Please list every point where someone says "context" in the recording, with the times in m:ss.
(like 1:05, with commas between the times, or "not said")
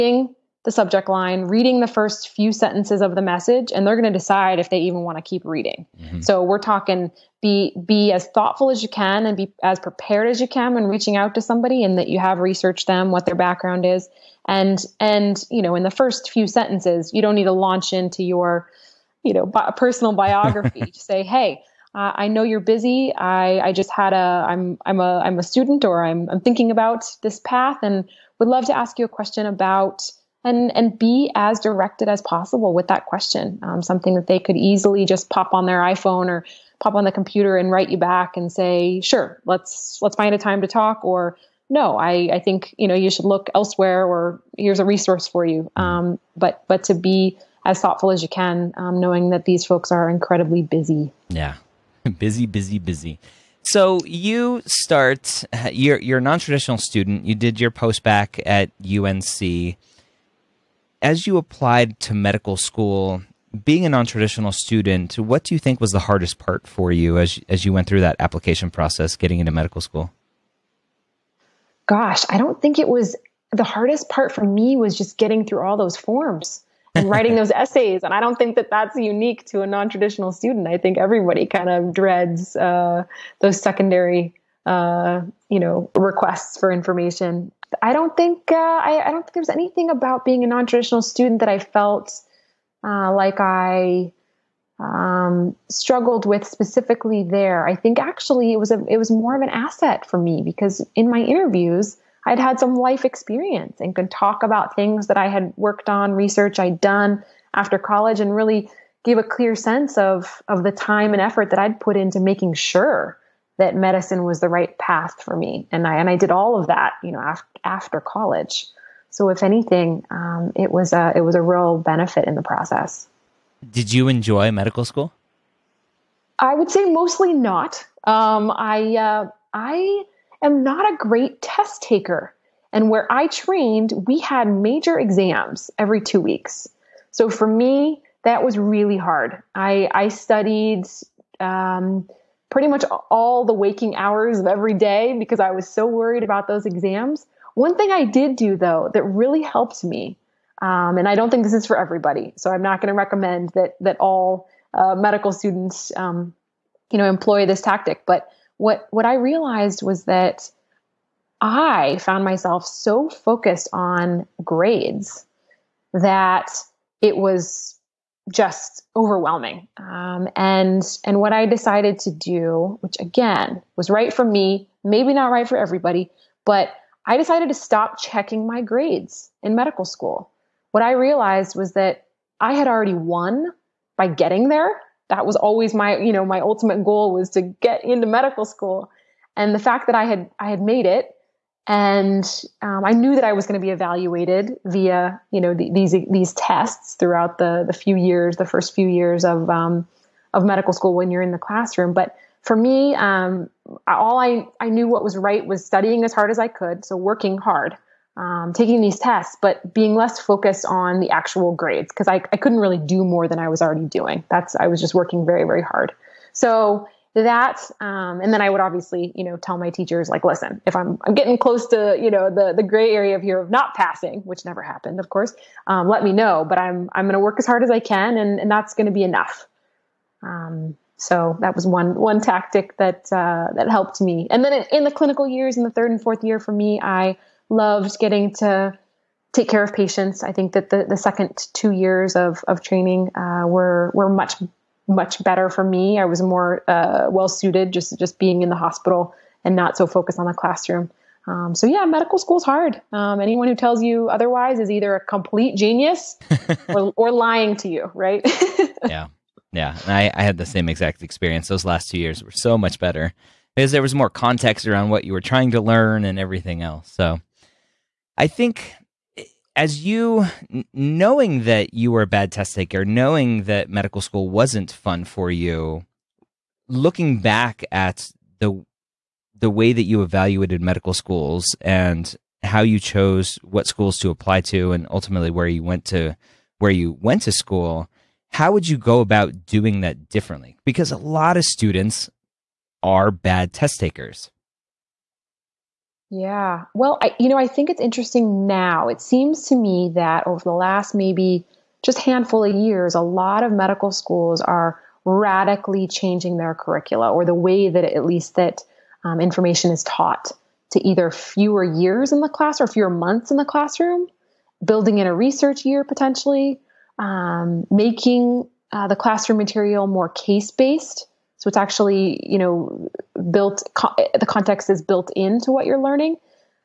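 4:24, 5:24.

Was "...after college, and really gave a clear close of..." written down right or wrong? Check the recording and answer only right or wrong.
wrong.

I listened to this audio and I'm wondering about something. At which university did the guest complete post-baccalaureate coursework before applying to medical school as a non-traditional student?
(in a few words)
UNC.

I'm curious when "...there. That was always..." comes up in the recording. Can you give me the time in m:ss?
3:04.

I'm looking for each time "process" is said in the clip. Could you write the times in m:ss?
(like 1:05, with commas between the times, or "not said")
1:08, 2:02.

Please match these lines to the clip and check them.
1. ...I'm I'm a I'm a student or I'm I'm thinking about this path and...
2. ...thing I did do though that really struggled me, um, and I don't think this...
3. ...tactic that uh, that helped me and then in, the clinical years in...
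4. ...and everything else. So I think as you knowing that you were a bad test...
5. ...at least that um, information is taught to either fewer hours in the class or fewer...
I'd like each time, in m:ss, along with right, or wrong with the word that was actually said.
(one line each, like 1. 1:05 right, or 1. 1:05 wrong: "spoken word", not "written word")
1. 0:24 right
2. 2:27 wrong: "helped", not "struggled"
3. 3:52 right
4. 4:26 right
5. 5:07 wrong: "years", not "hours".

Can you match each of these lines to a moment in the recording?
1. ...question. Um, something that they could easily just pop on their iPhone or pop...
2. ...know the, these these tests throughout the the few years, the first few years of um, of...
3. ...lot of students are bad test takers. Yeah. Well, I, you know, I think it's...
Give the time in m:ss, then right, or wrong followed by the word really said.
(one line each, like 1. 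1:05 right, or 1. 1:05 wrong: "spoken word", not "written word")
1. 0:33 right
2. 3:15 right
3. 4:50 right.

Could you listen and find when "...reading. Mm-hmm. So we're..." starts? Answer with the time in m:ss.
0:05.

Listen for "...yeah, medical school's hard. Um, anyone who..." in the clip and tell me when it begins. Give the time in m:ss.
4:11.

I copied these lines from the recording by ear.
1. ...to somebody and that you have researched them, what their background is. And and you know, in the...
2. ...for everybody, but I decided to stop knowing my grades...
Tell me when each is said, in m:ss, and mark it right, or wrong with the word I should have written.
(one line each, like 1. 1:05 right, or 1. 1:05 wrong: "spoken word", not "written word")
1. 0:11 right
2. 2:55 wrong: "checking", not "knowing".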